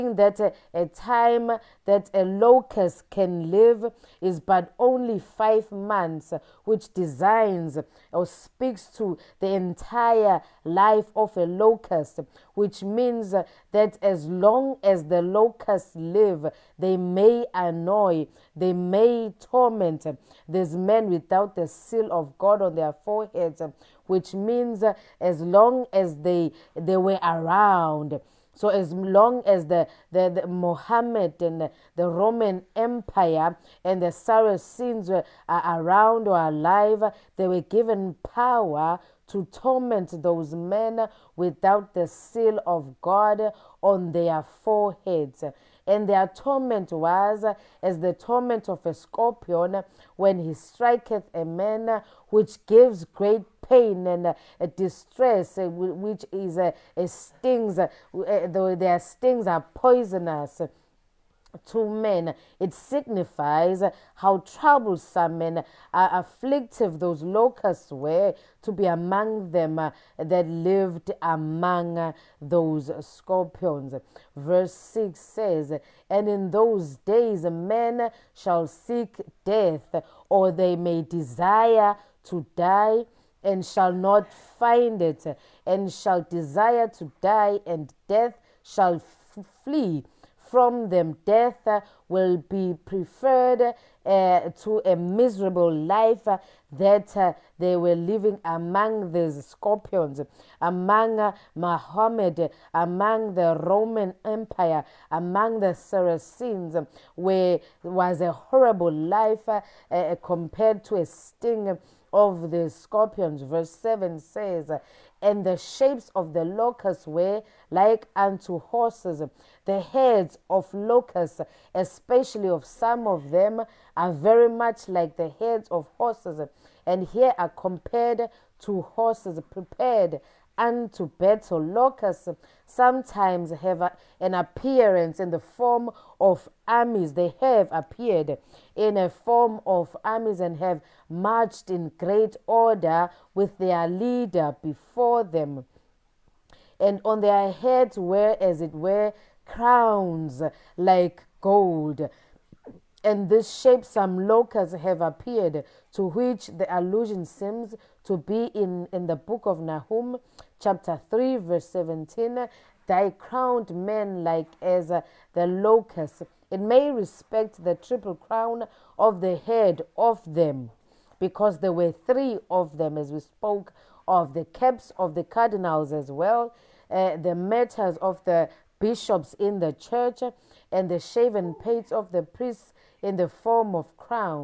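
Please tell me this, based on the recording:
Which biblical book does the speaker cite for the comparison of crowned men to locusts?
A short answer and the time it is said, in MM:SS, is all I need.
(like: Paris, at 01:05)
Nahum, at 02:39.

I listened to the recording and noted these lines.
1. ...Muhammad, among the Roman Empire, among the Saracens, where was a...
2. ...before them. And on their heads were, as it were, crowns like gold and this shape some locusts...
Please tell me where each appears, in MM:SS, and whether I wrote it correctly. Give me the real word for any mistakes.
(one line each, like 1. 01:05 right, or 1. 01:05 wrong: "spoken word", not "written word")
1. 01:41 right
2. 02:24 right.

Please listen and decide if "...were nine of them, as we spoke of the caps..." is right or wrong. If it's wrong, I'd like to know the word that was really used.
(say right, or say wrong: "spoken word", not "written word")
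wrong: "three", not "nine".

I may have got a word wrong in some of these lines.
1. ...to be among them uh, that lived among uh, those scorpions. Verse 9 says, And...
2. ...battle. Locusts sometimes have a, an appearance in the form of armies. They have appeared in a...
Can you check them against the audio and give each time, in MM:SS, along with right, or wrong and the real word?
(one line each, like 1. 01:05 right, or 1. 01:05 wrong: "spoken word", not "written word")
1. 01:08 wrong: "6", not "9"
2. 02:11 right.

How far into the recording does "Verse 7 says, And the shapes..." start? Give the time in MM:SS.
01:53.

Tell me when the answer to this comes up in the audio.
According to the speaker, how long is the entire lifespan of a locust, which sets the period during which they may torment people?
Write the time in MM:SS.
00:05.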